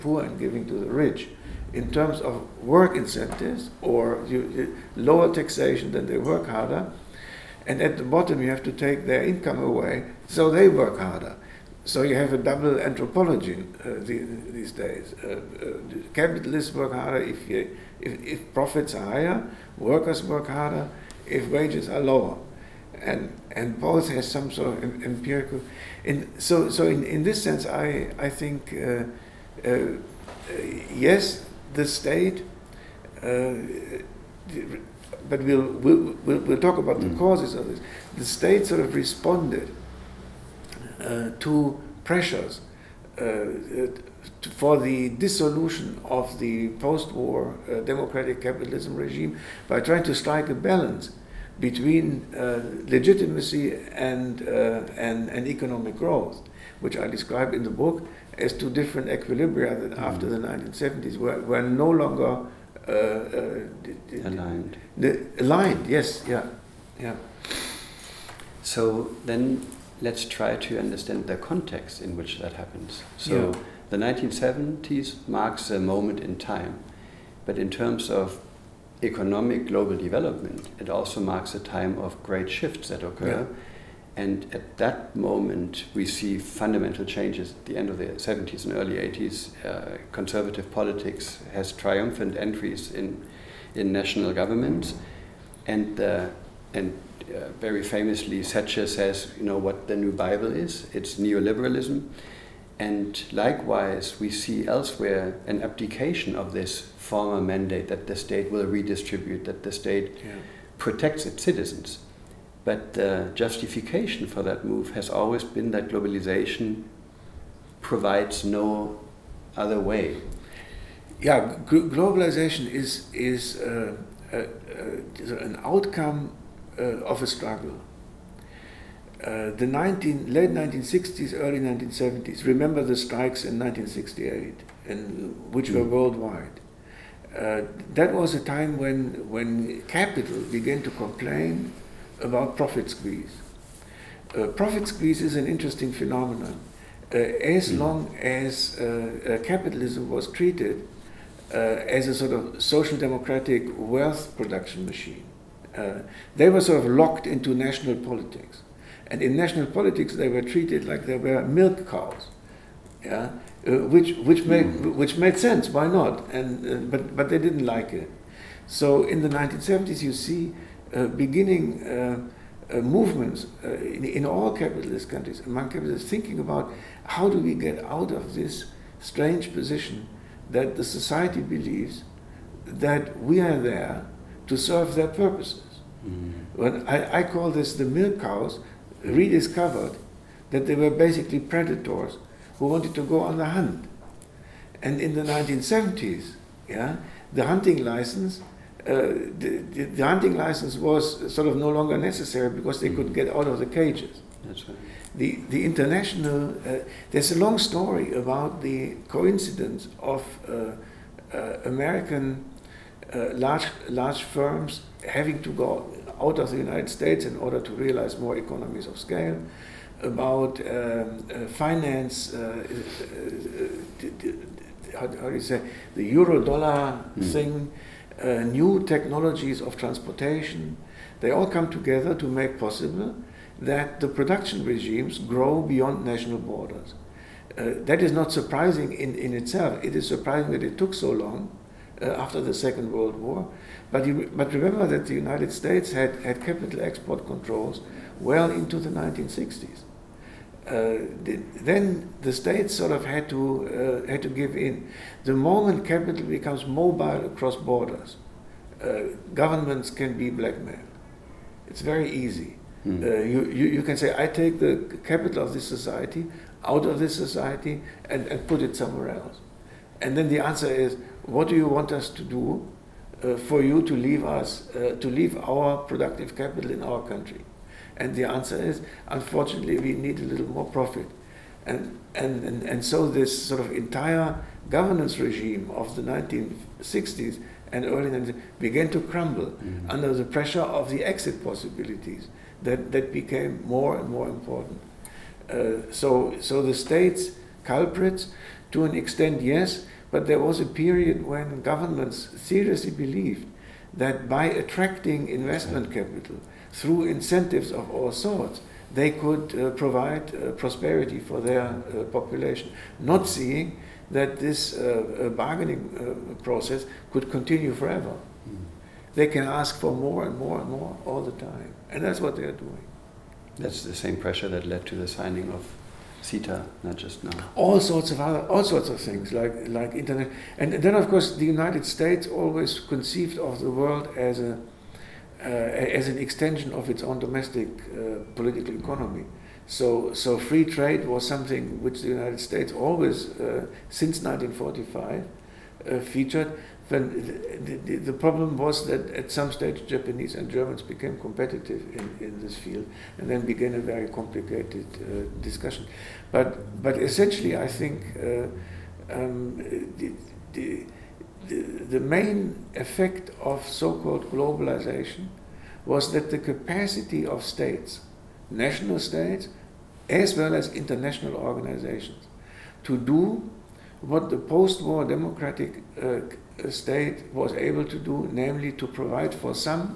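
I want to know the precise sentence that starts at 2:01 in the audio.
Yeah, globalization is, is uh, uh, uh an outcome uh, of a struggle.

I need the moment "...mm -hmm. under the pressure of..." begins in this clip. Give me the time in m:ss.
4:49.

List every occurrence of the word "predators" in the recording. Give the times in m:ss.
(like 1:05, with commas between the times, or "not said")
3:11.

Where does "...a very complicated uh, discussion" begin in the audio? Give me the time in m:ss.
5:53.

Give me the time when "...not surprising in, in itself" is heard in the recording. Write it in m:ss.
3:58.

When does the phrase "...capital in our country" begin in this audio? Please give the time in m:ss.
4:36.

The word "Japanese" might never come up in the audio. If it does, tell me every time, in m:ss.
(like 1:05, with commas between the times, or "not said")
5:49.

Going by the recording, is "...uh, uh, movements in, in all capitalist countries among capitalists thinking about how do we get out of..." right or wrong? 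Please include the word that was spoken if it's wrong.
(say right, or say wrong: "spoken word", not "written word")
right.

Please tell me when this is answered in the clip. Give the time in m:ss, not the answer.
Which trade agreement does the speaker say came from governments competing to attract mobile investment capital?
5:26.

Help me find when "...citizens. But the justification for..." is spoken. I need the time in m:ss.
1:51.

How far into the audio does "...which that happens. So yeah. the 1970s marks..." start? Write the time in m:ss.
1:12.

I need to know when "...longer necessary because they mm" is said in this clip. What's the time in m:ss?
3:21.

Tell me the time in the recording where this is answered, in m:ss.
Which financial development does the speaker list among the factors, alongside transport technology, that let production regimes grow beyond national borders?
3:46.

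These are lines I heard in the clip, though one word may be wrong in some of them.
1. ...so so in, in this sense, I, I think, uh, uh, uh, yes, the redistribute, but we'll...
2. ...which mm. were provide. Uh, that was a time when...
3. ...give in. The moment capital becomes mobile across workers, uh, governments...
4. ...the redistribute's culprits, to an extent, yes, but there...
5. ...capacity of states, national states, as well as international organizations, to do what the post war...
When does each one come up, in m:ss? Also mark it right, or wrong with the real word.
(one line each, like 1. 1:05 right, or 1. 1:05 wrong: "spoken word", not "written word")
1. 0:26 wrong: "state", not "redistribute"
2. 2:15 wrong: "worldwide", not "provide"
3. 4:14 wrong: "borders", not "workers"
4. 4:56 wrong: "state", not "redistribute"
5. 6:06 right.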